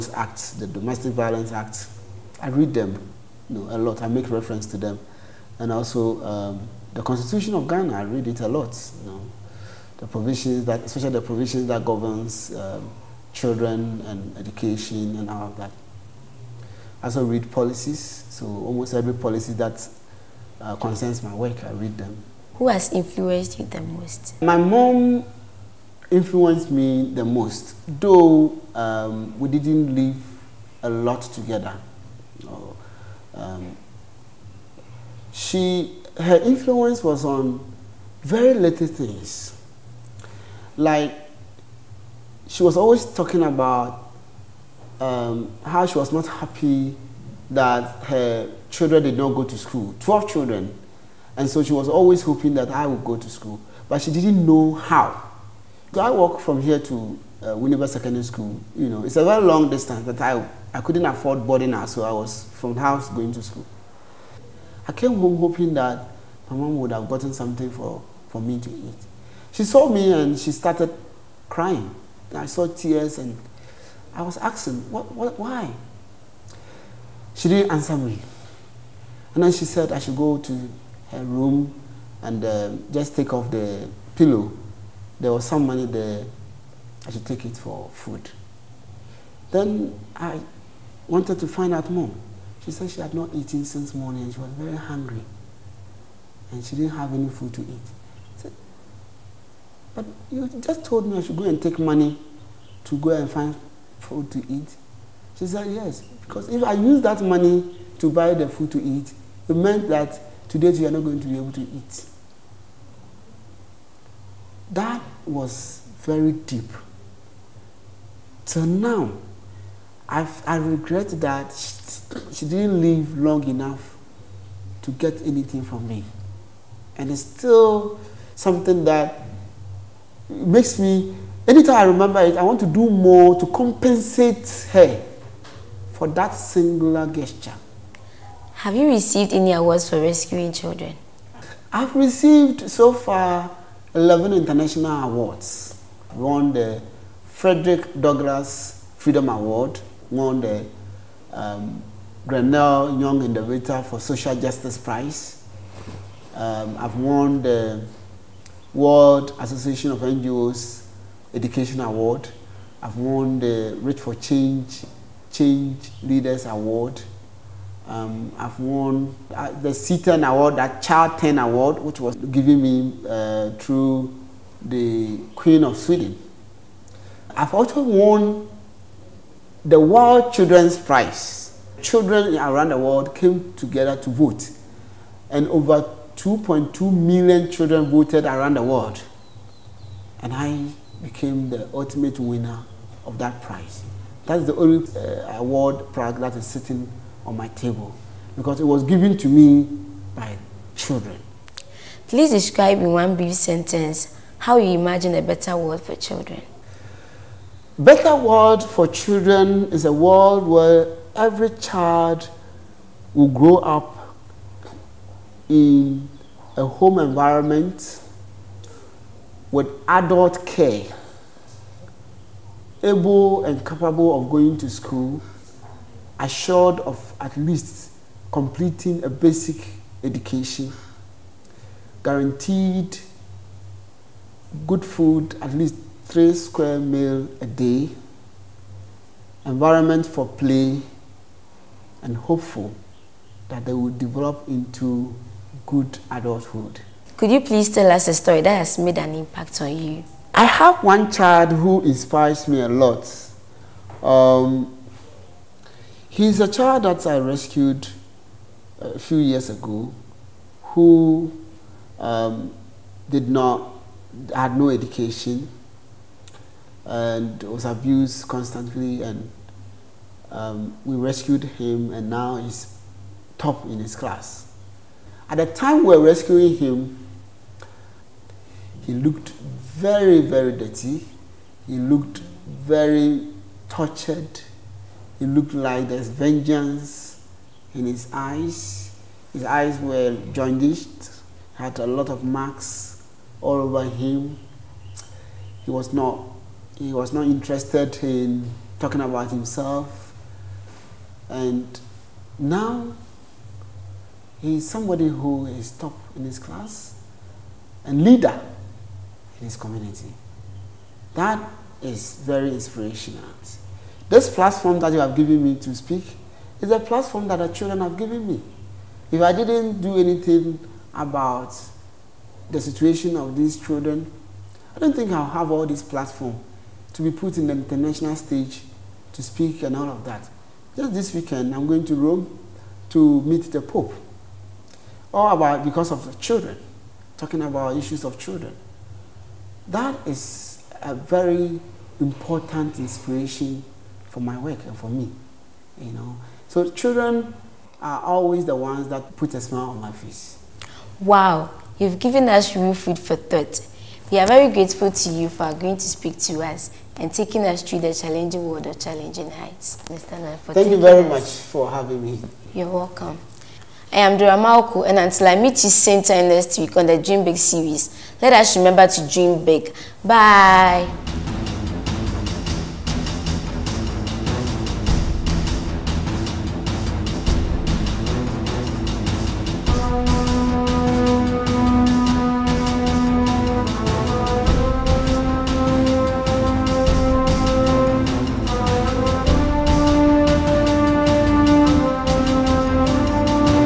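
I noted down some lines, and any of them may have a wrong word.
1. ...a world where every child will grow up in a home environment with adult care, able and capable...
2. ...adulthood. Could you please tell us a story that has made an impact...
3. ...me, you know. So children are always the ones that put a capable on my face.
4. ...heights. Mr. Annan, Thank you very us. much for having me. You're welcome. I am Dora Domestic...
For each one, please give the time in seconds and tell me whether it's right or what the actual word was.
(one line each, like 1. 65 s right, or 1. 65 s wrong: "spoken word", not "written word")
1. 209 s right
2. 246 s right
3. 344 s wrong: "smile", not "capable"
4. 359 s wrong: "Malko", not "Domestic".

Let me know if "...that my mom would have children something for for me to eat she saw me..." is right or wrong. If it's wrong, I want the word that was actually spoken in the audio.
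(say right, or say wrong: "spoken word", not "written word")
wrong: "gotten", not "children".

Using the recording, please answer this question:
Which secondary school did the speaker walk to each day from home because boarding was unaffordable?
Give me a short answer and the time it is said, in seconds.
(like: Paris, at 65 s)
Winneba Secondary School, at 57 s.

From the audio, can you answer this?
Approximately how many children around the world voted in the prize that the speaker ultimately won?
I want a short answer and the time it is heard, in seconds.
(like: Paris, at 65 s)
2.2 million, at 186 s.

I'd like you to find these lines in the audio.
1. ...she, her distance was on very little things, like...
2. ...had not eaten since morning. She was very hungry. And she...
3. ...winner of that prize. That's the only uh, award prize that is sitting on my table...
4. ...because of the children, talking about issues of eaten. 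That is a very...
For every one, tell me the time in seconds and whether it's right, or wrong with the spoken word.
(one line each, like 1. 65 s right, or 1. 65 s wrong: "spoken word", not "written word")
1. 35 s wrong: "influence", not "distance"
2. 93 s right
3. 192 s right
4. 335 s wrong: "children", not "eaten".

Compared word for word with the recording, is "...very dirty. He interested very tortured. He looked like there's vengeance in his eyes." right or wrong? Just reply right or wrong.
wrong.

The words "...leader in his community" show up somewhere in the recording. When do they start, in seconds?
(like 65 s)
308 s.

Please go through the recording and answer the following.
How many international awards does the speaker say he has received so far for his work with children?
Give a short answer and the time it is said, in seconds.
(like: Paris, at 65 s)
11, at 143 s.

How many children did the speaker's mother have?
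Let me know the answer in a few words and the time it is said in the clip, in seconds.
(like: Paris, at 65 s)
12, at 49 s.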